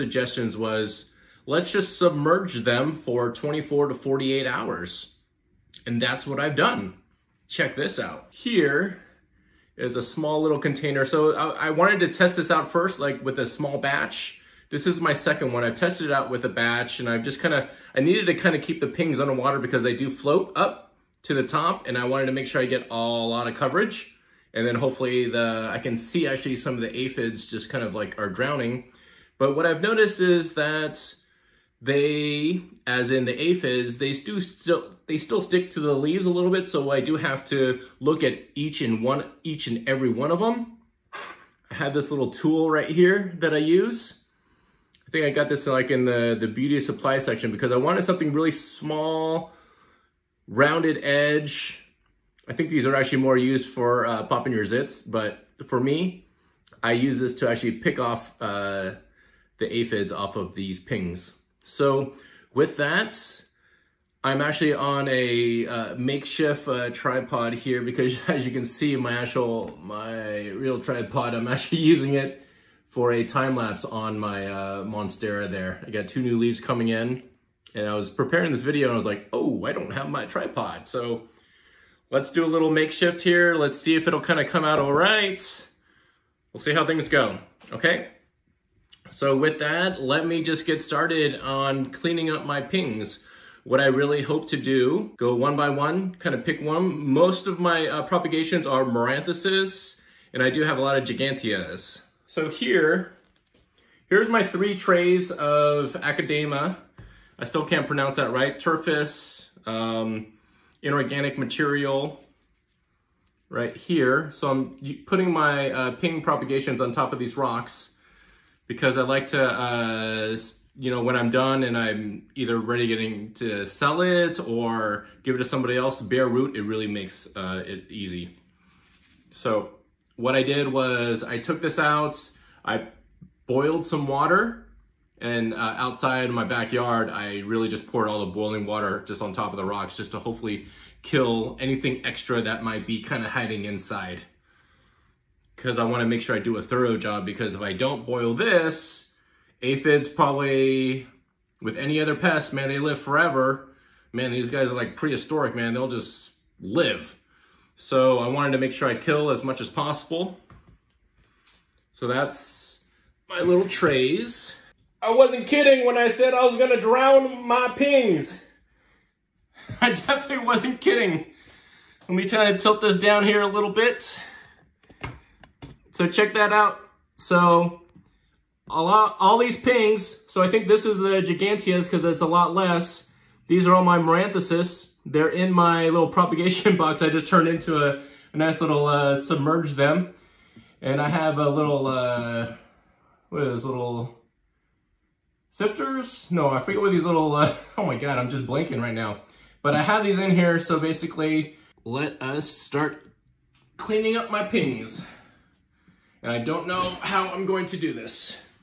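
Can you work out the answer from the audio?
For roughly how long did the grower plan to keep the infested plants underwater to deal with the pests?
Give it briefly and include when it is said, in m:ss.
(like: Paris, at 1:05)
24 to 48 hours, at 0:03.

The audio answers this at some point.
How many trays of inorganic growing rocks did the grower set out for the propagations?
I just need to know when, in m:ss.
1:44.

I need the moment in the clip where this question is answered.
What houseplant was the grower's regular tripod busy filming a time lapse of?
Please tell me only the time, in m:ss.
1:14.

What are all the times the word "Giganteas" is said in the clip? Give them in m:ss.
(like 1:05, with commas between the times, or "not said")
1:41, 3:01.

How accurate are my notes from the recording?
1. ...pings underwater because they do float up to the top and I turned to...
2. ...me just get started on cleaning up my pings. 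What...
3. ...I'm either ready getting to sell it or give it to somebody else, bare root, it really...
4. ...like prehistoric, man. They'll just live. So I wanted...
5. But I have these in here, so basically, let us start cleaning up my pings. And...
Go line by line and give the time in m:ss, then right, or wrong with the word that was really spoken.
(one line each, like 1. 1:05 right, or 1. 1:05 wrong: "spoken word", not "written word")
1. 0:18 wrong: "wanted", not "turned"
2. 1:30 right
3. 2:01 right
4. 2:34 right
5. 3:19 right.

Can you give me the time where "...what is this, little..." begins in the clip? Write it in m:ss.
3:13.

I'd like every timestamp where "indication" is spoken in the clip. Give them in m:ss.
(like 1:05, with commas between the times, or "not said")
not said.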